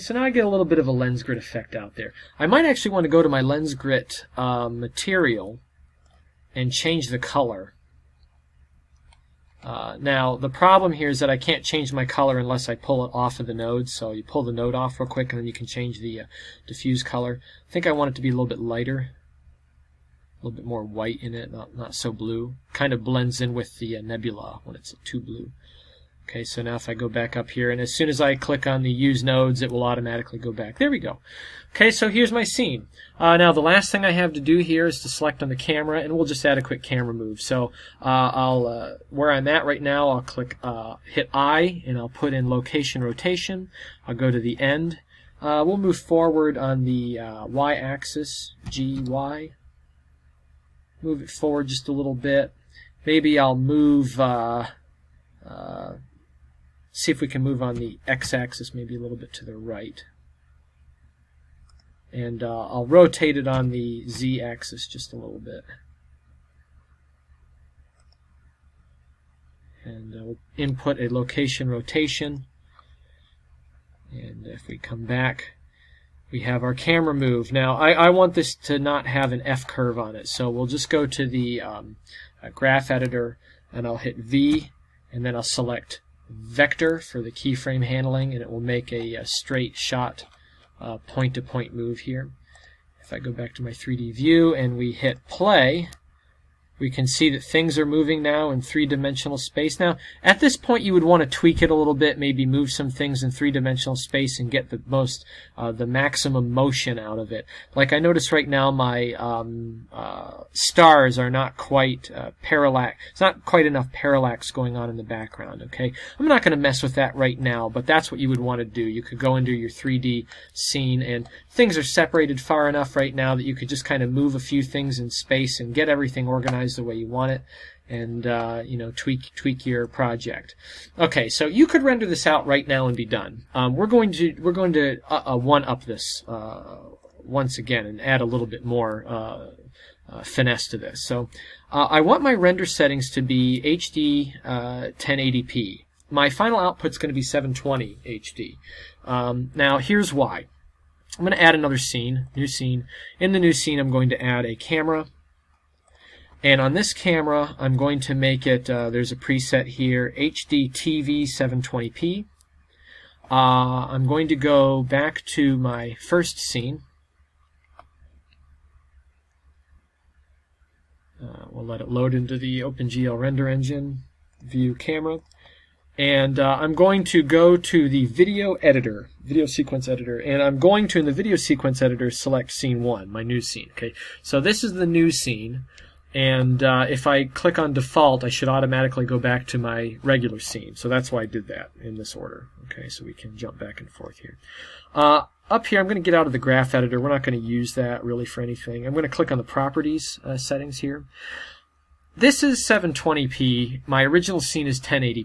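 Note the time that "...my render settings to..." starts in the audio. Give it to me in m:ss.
2:22.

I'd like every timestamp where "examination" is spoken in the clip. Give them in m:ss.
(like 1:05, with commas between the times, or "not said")
not said.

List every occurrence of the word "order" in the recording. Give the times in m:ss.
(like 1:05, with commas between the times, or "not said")
3:12.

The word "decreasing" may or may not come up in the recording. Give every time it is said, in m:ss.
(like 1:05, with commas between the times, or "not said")
not said.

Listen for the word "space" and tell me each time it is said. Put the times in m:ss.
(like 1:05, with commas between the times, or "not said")
1:39, 1:43, 2:05.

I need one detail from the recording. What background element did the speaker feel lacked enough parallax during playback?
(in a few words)
Stars.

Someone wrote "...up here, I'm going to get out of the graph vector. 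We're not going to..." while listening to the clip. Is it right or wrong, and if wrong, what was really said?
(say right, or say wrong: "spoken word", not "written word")
wrong: "editor", not "vector".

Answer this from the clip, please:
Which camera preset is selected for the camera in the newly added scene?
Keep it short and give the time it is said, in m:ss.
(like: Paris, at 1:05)
HD TV 720p, at 2:40.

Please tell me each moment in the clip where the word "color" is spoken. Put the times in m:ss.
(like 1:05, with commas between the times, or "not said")
0:07, 0:12, 0:17.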